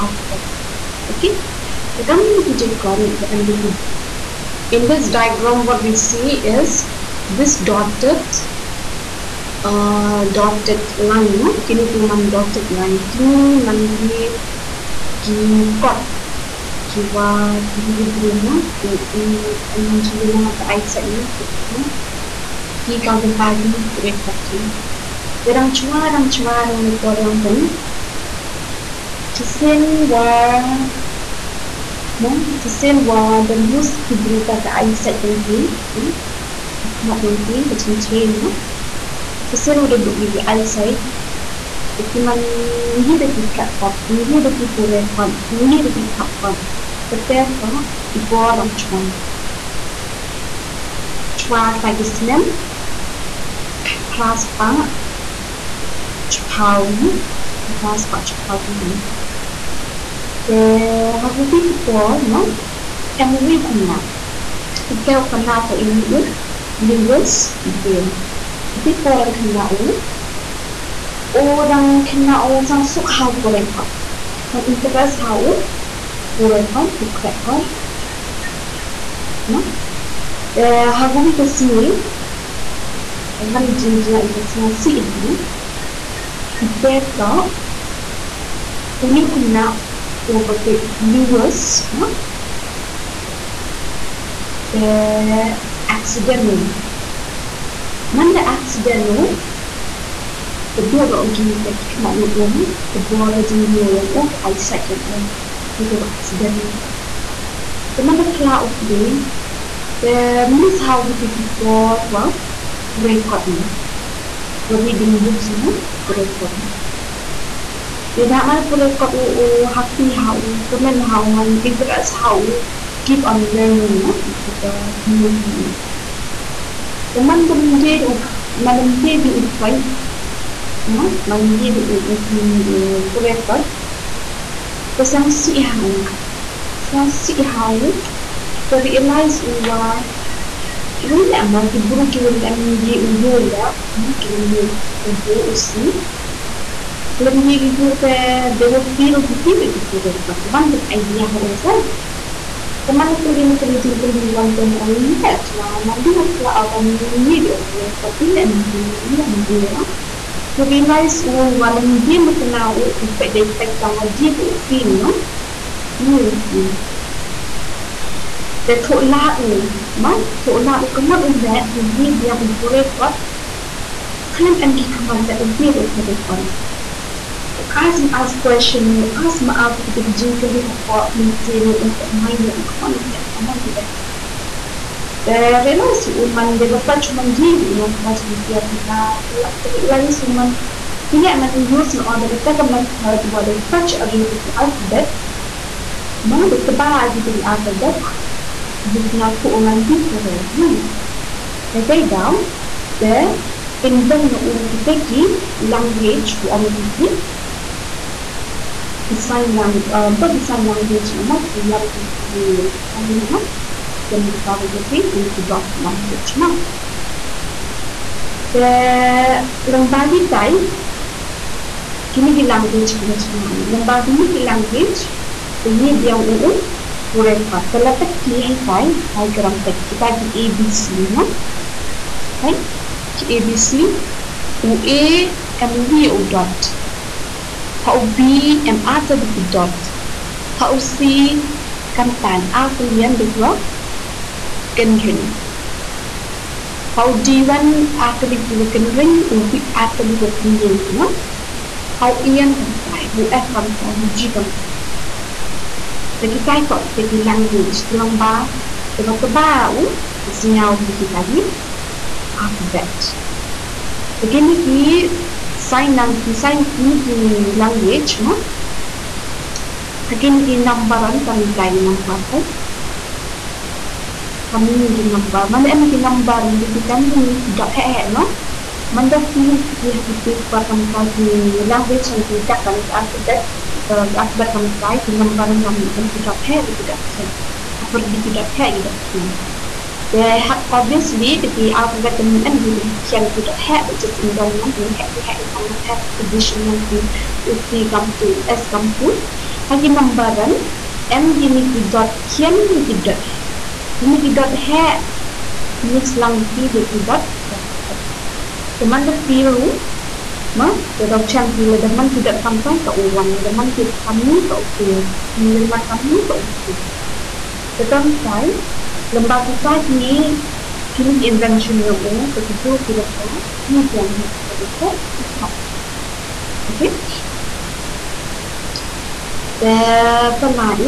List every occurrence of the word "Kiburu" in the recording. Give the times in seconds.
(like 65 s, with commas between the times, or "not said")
144 s.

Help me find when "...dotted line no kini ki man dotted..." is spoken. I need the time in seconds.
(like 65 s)
10 s.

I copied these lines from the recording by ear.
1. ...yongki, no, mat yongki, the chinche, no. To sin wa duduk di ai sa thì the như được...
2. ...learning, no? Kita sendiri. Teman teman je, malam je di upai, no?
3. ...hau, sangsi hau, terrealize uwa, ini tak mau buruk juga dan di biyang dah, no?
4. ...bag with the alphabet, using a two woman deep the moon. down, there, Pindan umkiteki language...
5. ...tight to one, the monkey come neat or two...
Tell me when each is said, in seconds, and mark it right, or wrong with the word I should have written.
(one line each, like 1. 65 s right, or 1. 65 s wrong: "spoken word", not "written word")
1. 35 s right
2. 123 s right
3. 135 s wrong: "ujung", not "biyang"
4. 196 s right
5. 312 s right.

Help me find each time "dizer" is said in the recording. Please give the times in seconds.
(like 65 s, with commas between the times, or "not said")
83 s.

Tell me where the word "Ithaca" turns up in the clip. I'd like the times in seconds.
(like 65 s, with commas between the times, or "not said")
86 s.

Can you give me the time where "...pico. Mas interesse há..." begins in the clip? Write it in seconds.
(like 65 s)
73 s.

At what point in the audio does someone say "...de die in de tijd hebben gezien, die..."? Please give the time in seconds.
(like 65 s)
149 s.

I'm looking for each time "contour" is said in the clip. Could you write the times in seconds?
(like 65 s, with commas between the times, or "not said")
not said.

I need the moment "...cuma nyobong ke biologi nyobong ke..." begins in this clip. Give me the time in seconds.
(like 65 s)
101 s.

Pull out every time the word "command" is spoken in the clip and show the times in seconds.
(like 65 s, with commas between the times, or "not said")
174 s, 183 s.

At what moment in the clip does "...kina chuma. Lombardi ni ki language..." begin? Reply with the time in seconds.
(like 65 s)
222 s.